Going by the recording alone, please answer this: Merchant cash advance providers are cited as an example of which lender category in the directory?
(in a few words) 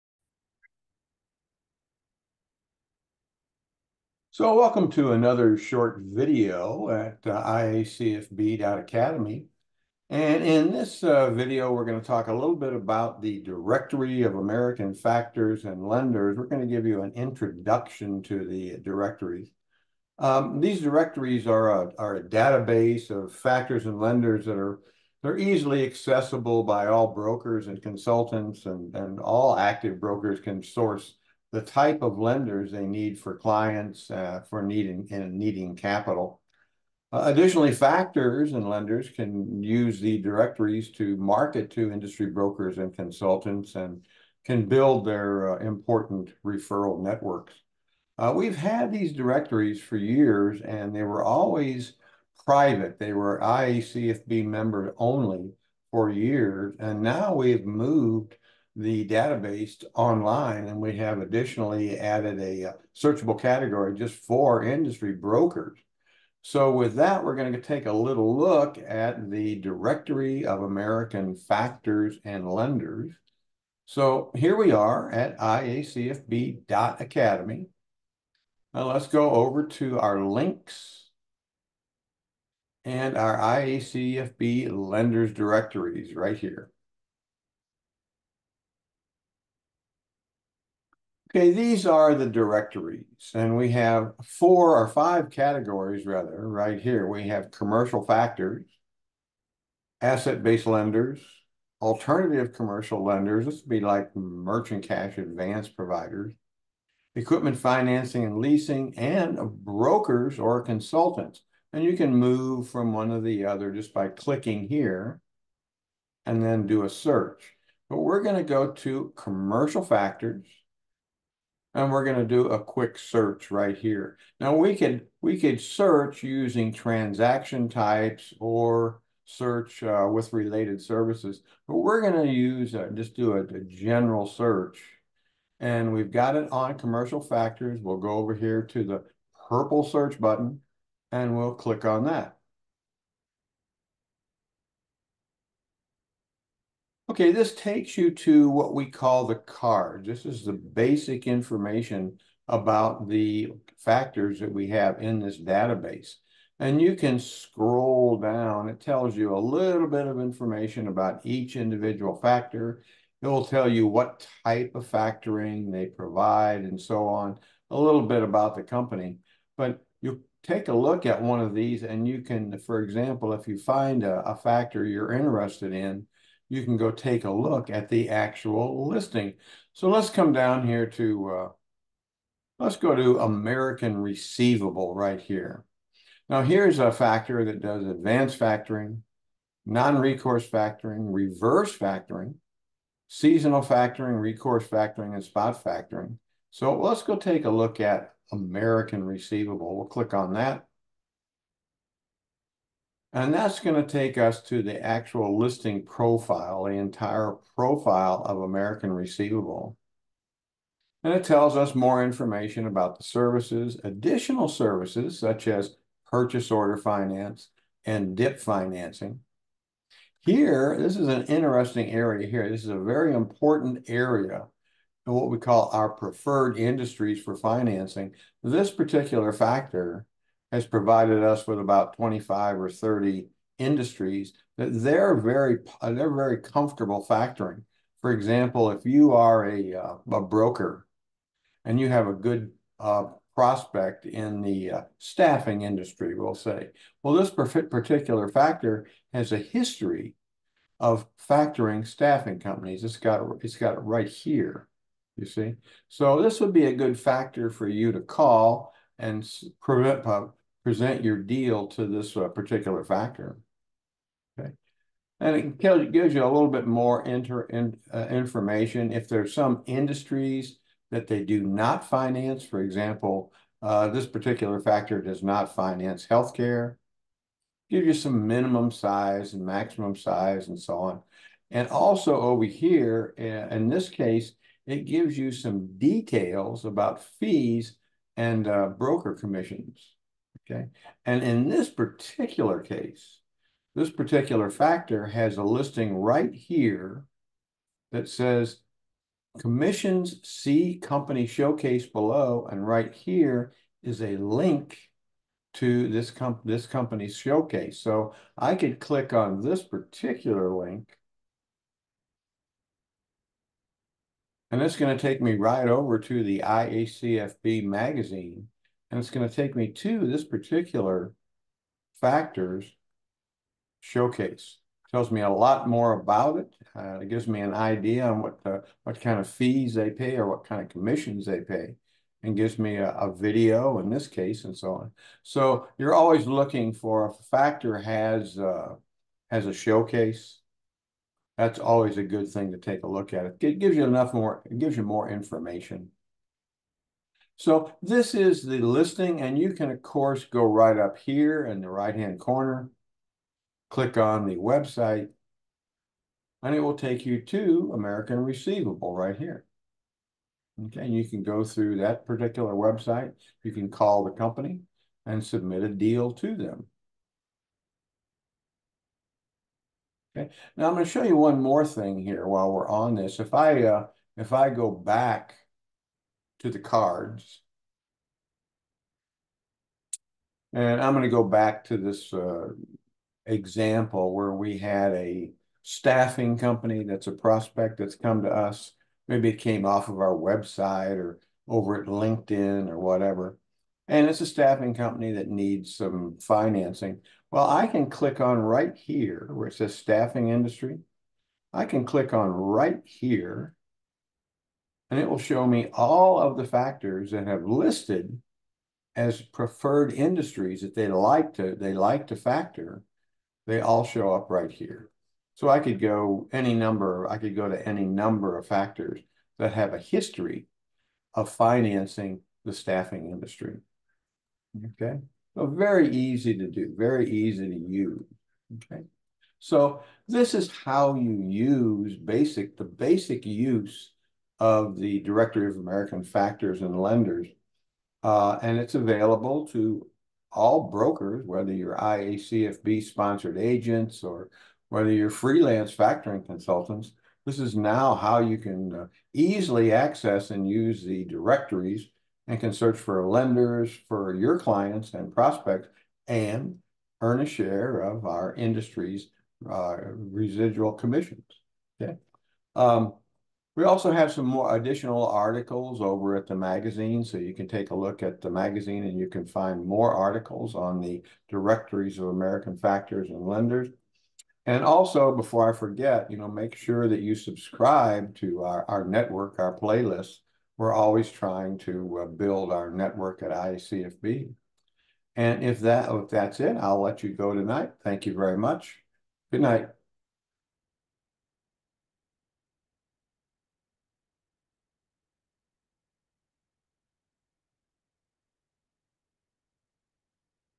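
Alternative commercial lenders.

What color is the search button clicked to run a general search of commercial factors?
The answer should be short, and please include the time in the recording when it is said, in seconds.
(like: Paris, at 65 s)
Purple, at 139 s.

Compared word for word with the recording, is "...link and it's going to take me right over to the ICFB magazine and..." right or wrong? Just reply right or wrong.
wrong.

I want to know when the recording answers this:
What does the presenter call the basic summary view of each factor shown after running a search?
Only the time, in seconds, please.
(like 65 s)
149 s.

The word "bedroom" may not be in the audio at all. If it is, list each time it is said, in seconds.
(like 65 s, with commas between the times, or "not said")
not said.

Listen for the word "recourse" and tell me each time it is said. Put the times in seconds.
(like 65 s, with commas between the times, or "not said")
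189 s, 194 s.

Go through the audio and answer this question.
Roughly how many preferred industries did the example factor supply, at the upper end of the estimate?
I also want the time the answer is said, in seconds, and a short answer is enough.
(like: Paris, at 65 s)
30, at 232 s.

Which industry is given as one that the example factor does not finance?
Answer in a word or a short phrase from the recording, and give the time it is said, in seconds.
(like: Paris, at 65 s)
Healthcare, at 276 s.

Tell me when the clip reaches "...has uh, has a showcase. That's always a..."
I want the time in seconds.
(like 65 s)
337 s.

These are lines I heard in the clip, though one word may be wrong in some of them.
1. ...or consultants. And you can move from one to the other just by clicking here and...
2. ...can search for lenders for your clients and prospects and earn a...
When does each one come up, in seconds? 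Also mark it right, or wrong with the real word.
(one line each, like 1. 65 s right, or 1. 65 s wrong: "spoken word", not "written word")
1. 110 s right
2. 452 s right.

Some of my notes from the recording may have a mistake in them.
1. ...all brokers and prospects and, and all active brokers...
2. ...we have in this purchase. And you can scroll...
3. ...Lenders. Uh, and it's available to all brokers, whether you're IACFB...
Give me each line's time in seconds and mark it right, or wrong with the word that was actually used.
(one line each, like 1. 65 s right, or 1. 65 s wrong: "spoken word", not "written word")
1. 26 s wrong: "consultants", not "prospects"
2. 154 s wrong: "database", not "purchase"
3. 436 s right.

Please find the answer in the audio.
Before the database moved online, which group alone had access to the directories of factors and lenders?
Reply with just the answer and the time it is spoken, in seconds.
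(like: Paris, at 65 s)
IACFB members, at 53 s.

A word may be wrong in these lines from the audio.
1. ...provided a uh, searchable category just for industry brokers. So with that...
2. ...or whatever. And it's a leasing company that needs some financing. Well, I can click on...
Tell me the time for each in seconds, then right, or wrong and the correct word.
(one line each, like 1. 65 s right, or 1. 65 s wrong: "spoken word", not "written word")
1. 61 s wrong: "added", not "provided"
2. 392 s wrong: "staffing", not "leasing".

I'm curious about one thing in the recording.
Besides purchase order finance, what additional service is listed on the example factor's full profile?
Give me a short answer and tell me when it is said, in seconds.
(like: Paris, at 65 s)
DIP financing, at 218 s.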